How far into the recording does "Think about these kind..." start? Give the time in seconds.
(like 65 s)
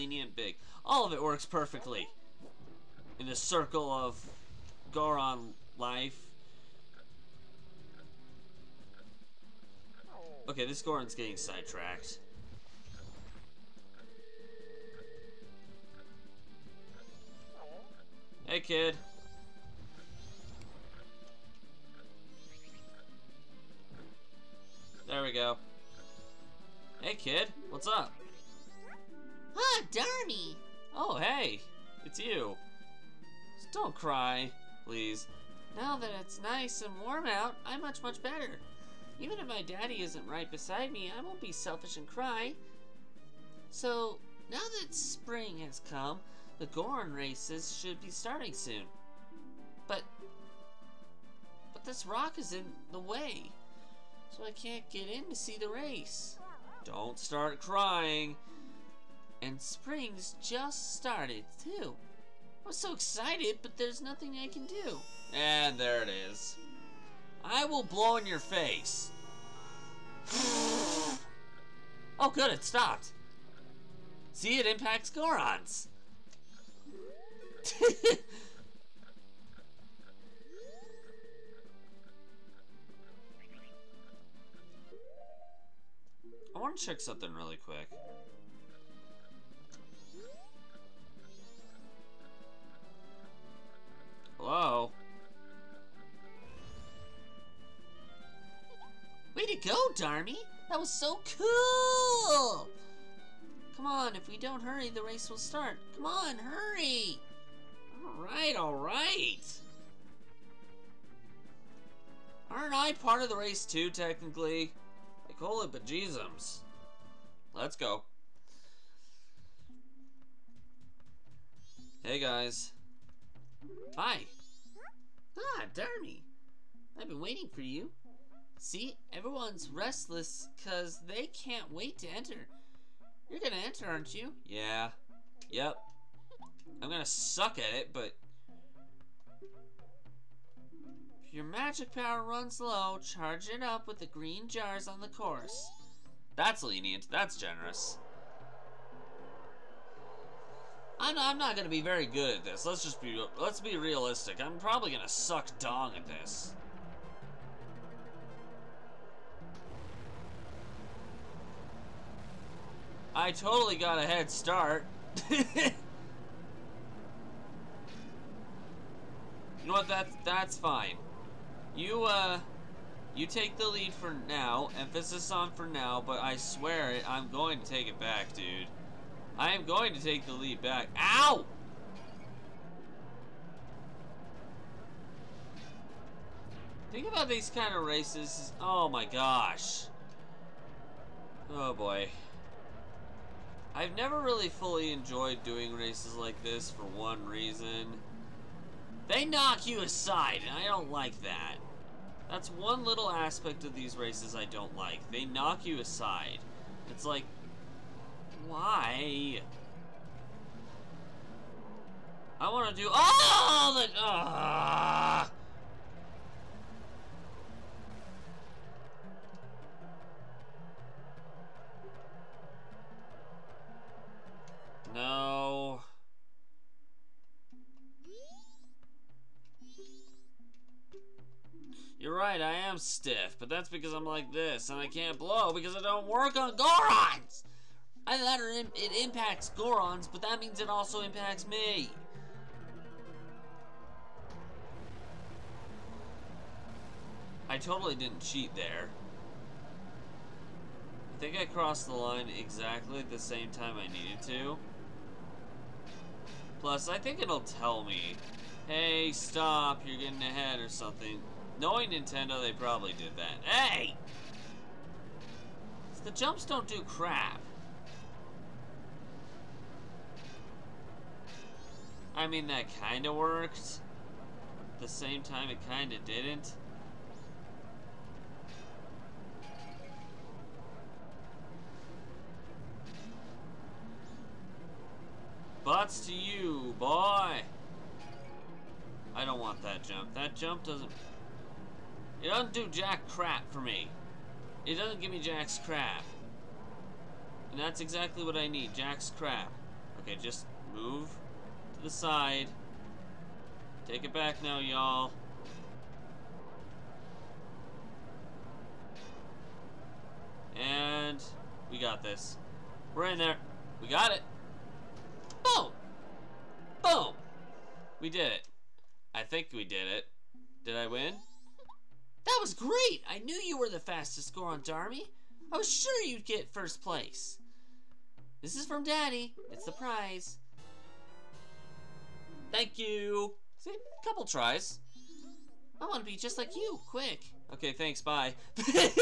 186 s.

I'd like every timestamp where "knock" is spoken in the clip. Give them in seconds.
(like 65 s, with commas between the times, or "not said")
199 s, 205 s.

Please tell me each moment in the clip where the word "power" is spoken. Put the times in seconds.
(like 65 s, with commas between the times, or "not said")
141 s.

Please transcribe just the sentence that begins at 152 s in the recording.
Let's just be let's be realistic.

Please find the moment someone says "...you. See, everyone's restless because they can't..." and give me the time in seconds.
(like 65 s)
127 s.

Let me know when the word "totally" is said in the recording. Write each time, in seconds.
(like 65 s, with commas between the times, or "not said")
163 s, 247 s.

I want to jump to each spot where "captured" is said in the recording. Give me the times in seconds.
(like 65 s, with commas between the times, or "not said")
not said.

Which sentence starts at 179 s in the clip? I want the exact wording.
I am going to take the lead back.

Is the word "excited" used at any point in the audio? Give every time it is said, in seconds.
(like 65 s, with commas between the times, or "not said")
62 s.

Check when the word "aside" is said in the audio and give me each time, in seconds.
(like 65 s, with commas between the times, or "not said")
199 s, 205 s.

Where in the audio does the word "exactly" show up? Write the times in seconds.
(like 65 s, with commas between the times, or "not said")
252 s, 297 s.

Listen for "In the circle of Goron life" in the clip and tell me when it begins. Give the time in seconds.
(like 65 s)
3 s.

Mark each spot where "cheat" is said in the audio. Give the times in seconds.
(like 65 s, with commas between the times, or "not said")
248 s.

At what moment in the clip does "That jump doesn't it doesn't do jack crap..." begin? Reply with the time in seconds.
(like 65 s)
290 s.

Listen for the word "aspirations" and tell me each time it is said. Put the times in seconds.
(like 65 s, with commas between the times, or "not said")
not said.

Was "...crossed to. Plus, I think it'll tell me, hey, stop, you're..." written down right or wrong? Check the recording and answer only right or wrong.
wrong.